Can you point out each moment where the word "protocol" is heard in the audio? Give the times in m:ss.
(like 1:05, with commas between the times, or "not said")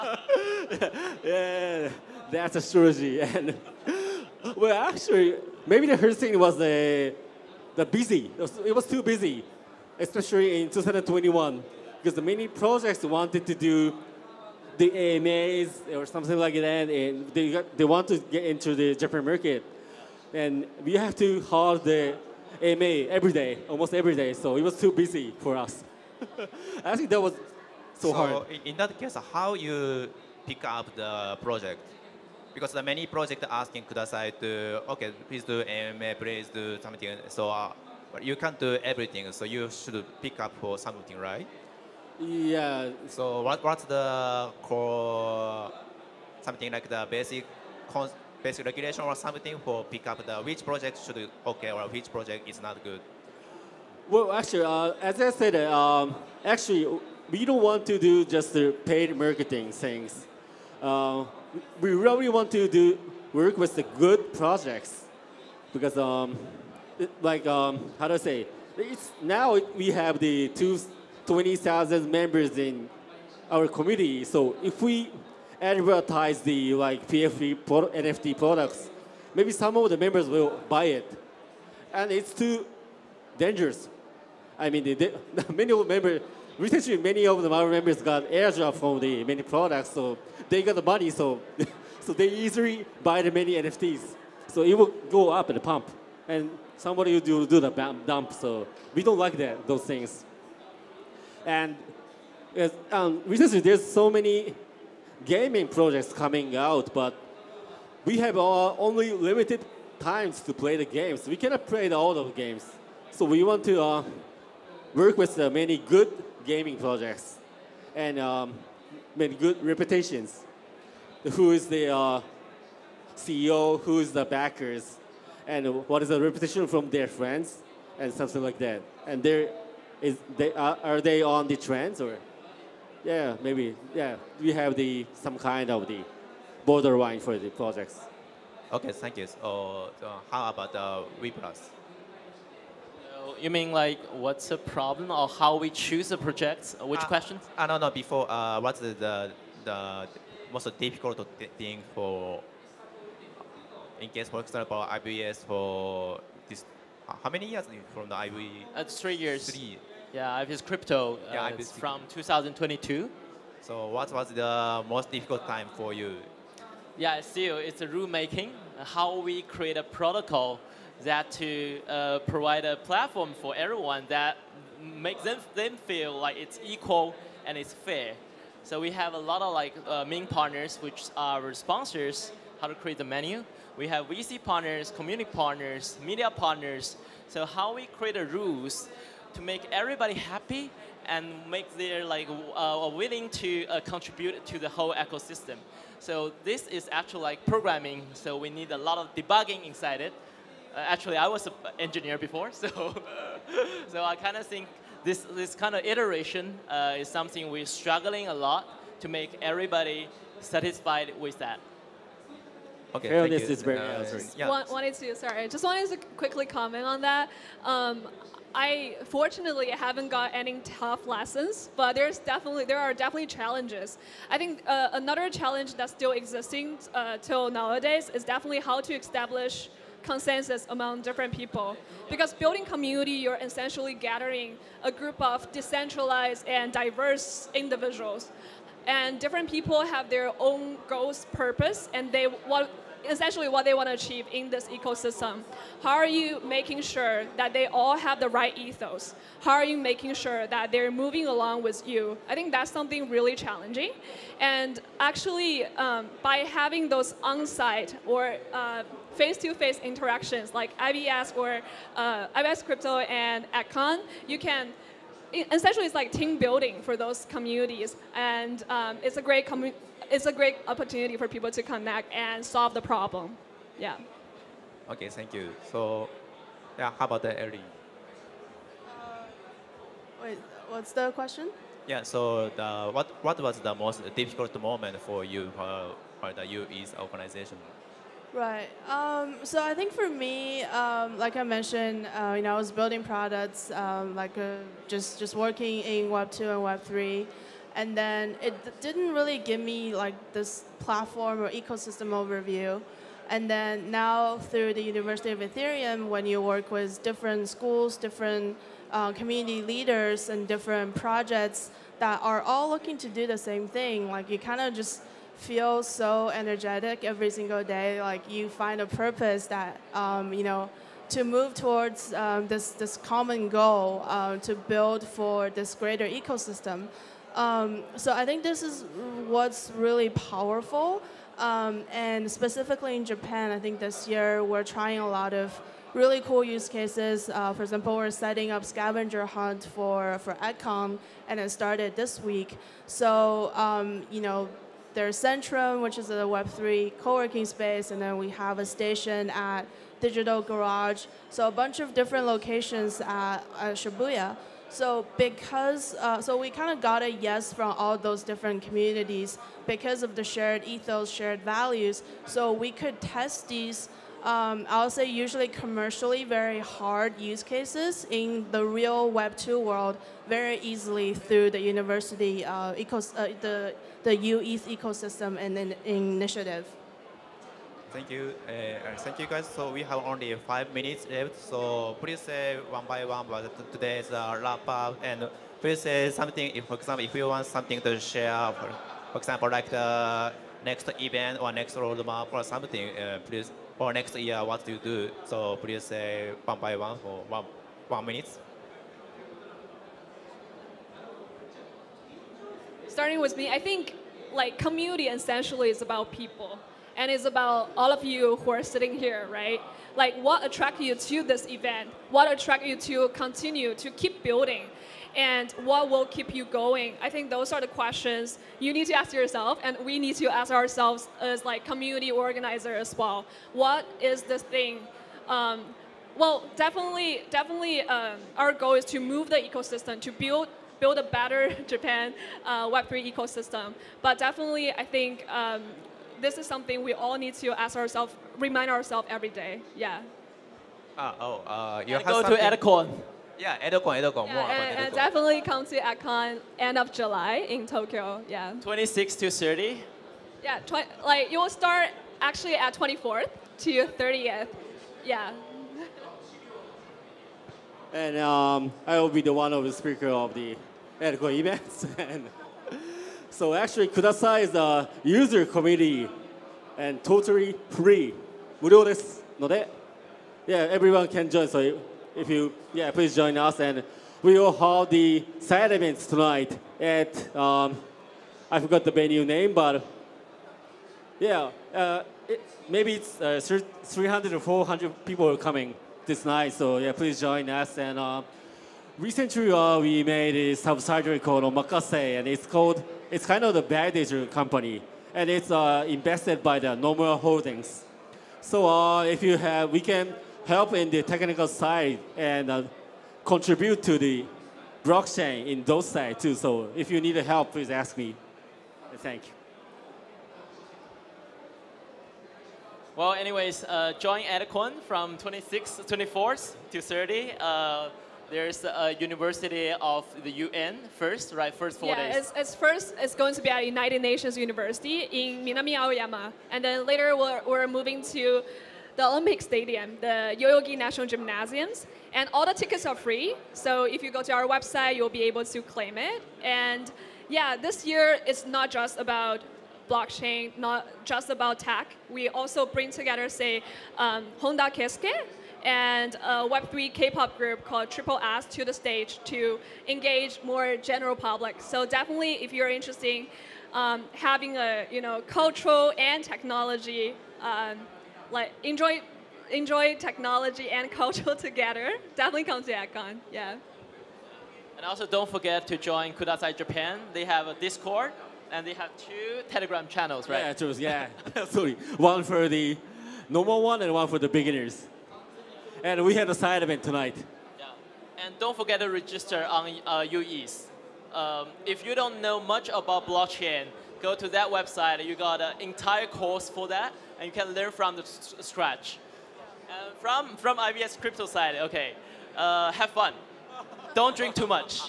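2:49.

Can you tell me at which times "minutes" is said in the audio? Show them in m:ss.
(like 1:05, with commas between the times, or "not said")
6:20, 6:38.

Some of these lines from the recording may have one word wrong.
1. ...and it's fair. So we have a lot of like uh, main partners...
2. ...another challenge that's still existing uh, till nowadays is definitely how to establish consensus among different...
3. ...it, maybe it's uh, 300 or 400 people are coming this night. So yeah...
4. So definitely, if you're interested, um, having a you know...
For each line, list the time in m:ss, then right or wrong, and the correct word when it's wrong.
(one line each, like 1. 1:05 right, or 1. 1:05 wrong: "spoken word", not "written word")
1. 2:57 right
2. 3:44 right
3. 8:02 right
4. 9:11 right.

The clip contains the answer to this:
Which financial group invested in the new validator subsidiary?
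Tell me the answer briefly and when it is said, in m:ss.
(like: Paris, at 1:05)
Nomura Holdings, at 8:16.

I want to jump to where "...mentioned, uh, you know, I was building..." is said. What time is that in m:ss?
4:51.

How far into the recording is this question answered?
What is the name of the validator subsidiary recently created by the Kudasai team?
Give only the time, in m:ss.
8:11.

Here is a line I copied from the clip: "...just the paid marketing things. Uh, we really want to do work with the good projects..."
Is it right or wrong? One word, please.
right.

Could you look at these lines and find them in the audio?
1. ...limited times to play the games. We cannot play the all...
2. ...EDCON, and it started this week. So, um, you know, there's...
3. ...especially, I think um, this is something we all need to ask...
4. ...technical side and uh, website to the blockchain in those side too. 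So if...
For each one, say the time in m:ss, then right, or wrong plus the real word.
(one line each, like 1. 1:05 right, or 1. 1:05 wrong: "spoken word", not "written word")
1. 1:49 right
2. 5:40 right
3. 7:14 wrong: "definitely", not "especially"
4. 8:21 wrong: "contribute", not "website".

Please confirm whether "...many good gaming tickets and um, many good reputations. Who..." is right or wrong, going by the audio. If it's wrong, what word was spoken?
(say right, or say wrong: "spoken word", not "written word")
wrong: "projects", not "tickets".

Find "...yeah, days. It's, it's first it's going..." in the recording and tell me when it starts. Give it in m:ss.
8:41.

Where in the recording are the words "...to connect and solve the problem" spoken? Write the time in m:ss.
4:31.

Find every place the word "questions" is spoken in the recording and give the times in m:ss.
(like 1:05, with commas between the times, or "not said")
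2:27, 4:41, 6:57.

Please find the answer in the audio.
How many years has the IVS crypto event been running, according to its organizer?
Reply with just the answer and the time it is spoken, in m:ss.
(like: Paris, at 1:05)
3, at 2:38.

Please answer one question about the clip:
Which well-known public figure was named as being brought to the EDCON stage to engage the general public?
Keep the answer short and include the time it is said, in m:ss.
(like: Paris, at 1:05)
Honda Keisuke, at 9:04.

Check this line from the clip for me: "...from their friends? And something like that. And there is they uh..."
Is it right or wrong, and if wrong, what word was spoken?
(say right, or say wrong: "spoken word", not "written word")
right.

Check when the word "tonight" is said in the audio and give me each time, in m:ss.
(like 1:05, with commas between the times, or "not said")
7:56, 9:36.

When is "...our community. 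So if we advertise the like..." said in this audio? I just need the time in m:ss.
1:13.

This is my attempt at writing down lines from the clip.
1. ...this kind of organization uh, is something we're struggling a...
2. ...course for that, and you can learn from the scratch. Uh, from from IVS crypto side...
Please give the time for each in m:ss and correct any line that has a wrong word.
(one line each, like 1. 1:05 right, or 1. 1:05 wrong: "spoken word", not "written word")
1. 3:25 wrong: "iteration", not "organization"
2. 9:46 right.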